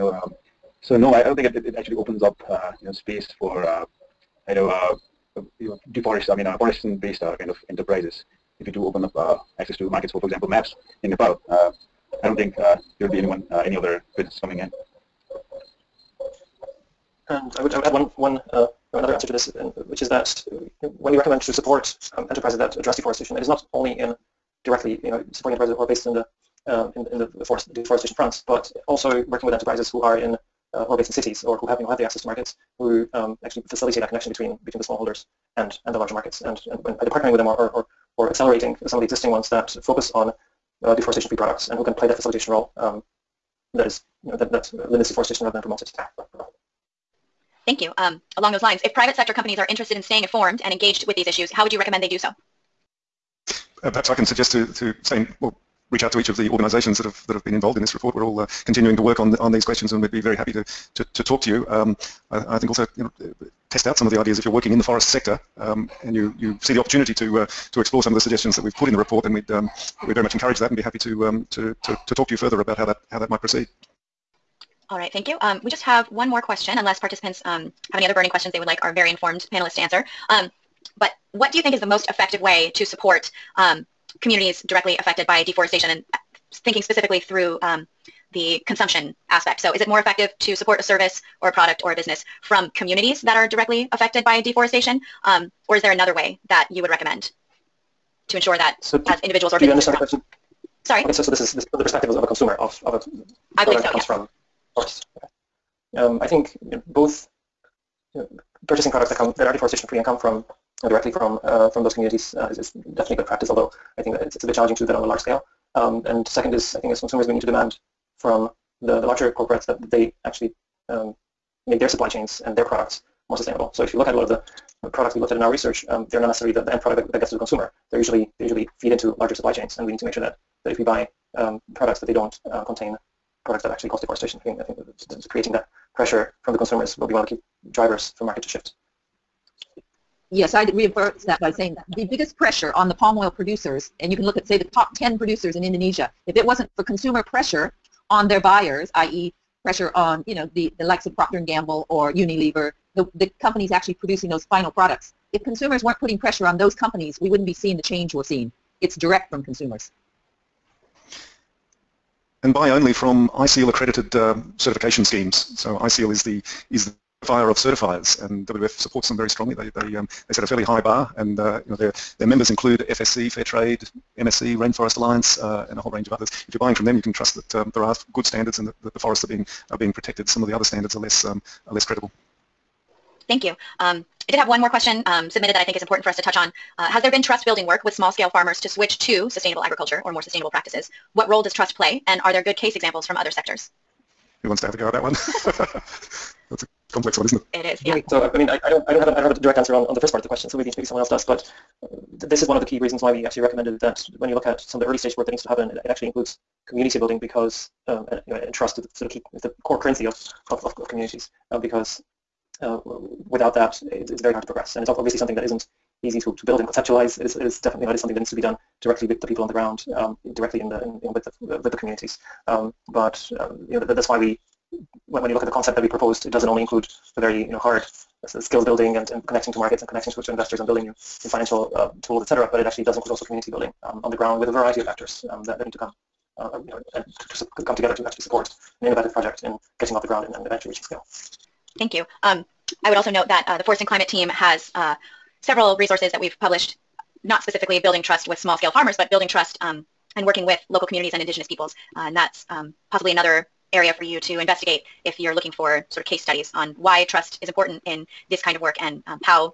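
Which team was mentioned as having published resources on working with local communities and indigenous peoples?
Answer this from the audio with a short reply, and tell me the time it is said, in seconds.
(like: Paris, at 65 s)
Forest and Climate team, at 243 s.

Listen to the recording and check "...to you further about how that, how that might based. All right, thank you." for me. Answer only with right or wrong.
wrong.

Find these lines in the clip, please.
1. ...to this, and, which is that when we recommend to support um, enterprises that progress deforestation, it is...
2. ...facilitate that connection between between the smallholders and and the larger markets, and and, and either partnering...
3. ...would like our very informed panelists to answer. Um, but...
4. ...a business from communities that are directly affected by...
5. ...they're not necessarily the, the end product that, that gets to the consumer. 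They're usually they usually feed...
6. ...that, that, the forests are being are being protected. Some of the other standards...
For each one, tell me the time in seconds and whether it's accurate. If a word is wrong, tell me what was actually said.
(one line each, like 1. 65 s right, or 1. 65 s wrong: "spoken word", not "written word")
1. 19 s wrong: "address", not "progress"
2. 33 s right
3. 78 s right
4. 91 s right
5. 126 s right
6. 178 s right.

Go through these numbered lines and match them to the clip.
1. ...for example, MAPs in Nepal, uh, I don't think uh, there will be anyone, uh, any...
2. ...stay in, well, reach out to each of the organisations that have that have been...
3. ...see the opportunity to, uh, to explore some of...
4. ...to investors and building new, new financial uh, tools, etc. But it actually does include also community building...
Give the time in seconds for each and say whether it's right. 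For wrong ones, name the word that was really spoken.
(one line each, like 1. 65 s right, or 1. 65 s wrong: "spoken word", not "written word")
1. 10 s right
2. 55 s right
3. 66 s right
4. 230 s right.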